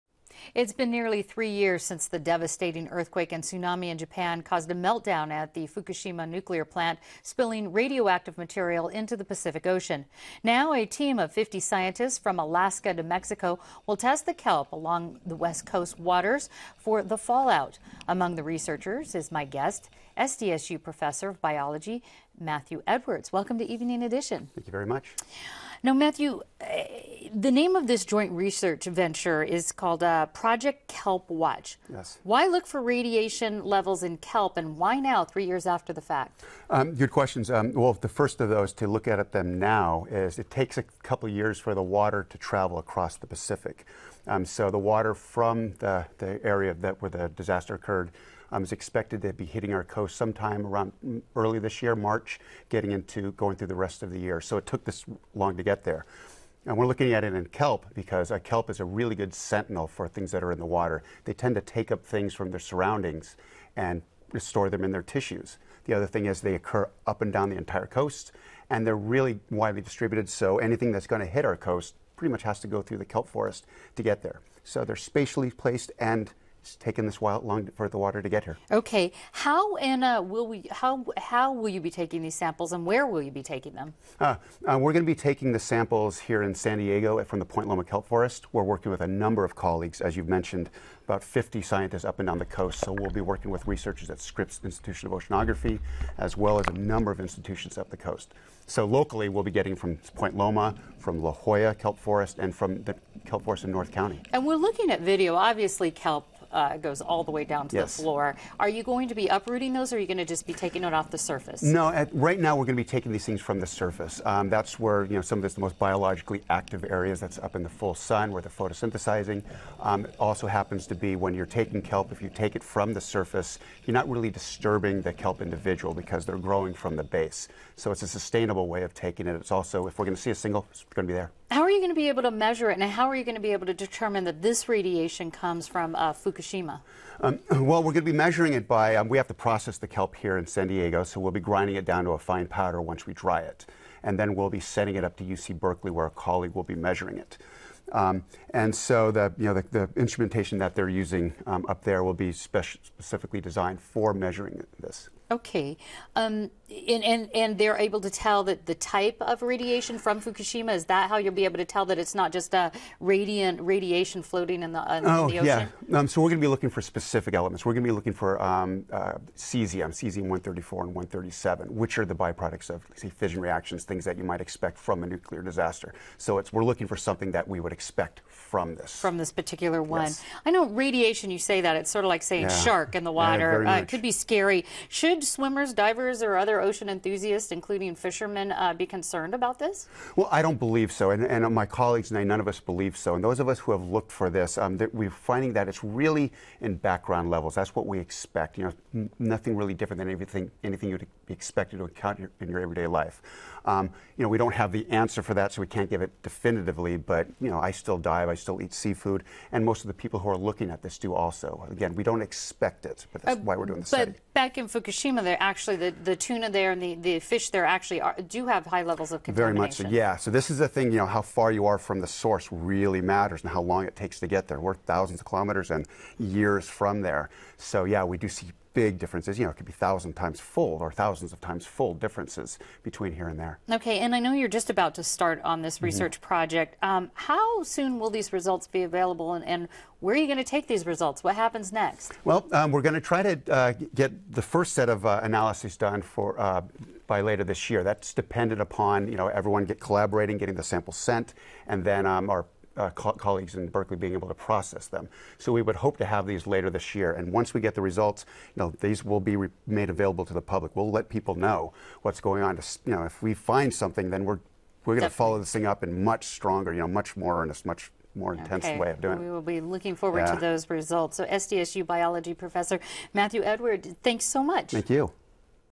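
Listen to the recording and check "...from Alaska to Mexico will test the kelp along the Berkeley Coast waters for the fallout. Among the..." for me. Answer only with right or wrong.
wrong.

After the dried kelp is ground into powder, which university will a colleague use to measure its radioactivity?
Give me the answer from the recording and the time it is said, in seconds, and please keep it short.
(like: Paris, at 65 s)
UC Berkeley, at 145 s.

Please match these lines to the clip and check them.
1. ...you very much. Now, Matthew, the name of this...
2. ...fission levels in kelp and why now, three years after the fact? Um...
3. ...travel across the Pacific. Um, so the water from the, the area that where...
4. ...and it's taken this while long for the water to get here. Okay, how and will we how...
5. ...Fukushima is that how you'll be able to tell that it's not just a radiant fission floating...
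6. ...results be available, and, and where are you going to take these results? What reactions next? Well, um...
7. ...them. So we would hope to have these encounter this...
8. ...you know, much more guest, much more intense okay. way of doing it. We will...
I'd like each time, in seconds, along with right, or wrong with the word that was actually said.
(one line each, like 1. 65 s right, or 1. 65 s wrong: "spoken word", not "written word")
1. 24 s right
2. 32 s wrong: "radiation", not "fission"
3. 42 s right
4. 75 s right
5. 160 s wrong: "radiation", not "fission"
6. 238 s wrong: "happens", not "reactions"
7. 254 s wrong: "later", not "encounter"
8. 266 s wrong: "earnest", not "guest".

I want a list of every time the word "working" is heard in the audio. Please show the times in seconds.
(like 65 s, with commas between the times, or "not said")
88 s, 93 s.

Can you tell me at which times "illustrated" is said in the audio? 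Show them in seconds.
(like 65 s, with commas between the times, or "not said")
not said.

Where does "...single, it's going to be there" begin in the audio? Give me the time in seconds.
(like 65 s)
130 s.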